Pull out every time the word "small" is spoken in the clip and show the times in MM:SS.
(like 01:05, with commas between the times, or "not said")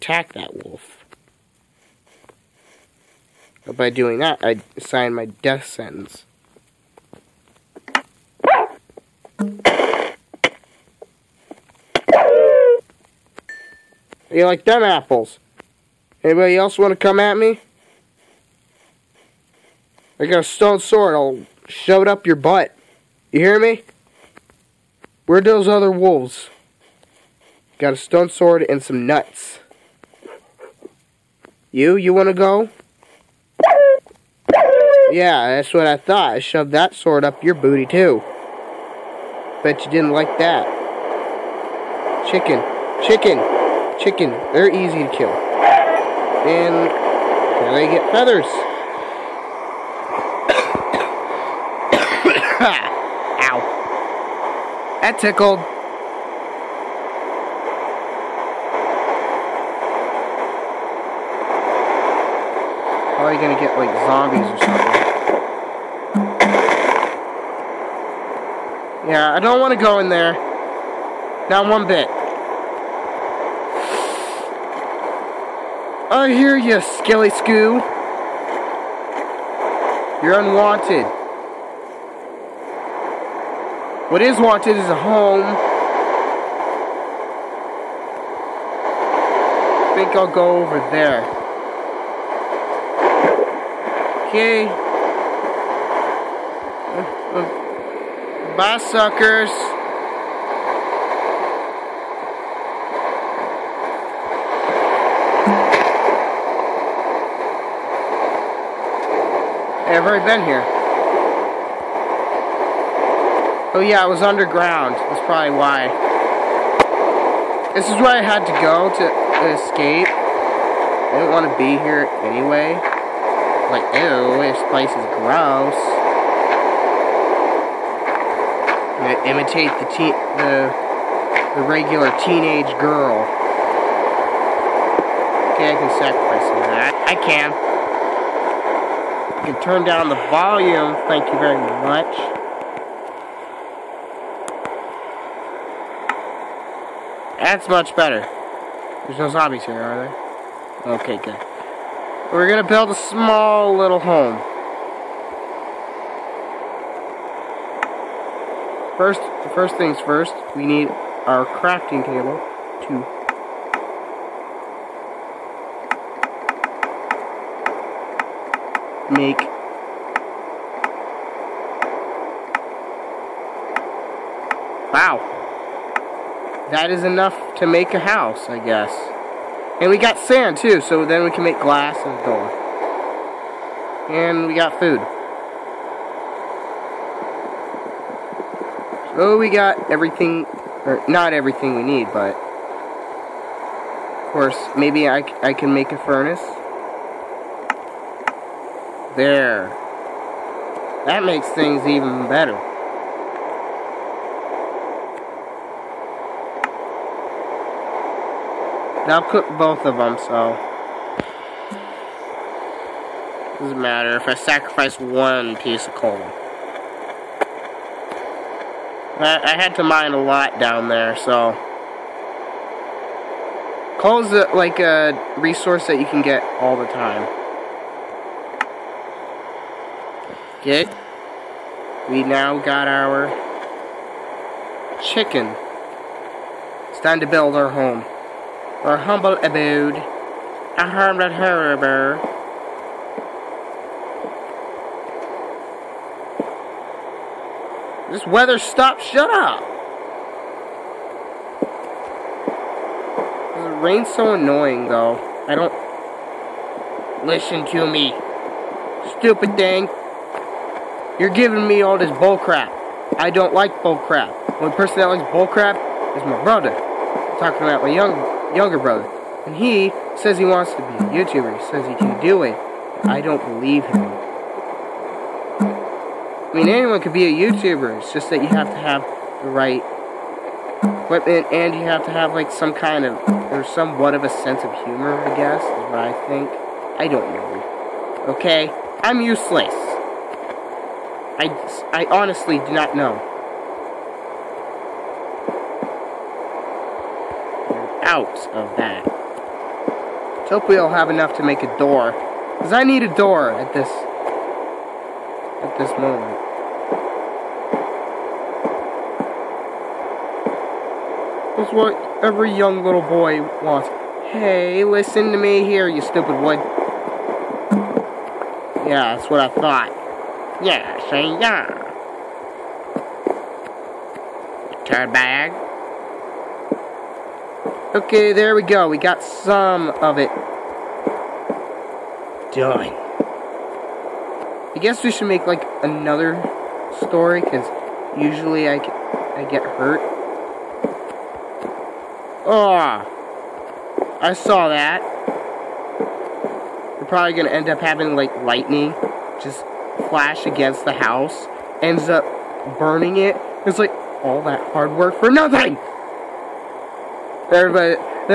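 02:32.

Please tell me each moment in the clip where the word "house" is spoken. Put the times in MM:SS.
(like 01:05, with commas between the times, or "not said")
02:58, 05:50.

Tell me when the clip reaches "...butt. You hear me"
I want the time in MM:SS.
00:22.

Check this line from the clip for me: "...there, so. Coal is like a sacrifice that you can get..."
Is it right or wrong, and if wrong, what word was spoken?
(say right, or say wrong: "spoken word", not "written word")
wrong: "resource", not "sacrifice".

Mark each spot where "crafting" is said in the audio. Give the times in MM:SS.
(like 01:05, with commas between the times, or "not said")
02:41.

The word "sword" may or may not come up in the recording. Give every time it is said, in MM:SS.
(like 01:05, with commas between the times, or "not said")
00:20, 00:28, 00:36.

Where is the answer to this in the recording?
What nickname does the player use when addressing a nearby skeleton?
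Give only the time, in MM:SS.
01:16.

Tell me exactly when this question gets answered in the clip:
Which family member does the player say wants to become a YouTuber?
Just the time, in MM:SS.
04:28.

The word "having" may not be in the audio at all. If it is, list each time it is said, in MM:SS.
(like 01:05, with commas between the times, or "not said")
05:47.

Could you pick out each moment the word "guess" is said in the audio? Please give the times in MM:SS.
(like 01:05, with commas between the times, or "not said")
02:58, 04:45, 05:34.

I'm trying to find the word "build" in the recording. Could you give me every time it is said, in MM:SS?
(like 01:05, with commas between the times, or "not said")
02:32, 03:57.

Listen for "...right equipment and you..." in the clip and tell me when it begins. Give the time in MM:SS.
04:39.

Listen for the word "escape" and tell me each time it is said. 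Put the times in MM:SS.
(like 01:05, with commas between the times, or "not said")
01:59.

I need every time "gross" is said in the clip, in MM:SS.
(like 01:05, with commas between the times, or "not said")
02:05.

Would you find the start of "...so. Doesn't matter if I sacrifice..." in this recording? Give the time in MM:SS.
03:30.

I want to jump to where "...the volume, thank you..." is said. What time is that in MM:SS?
02:20.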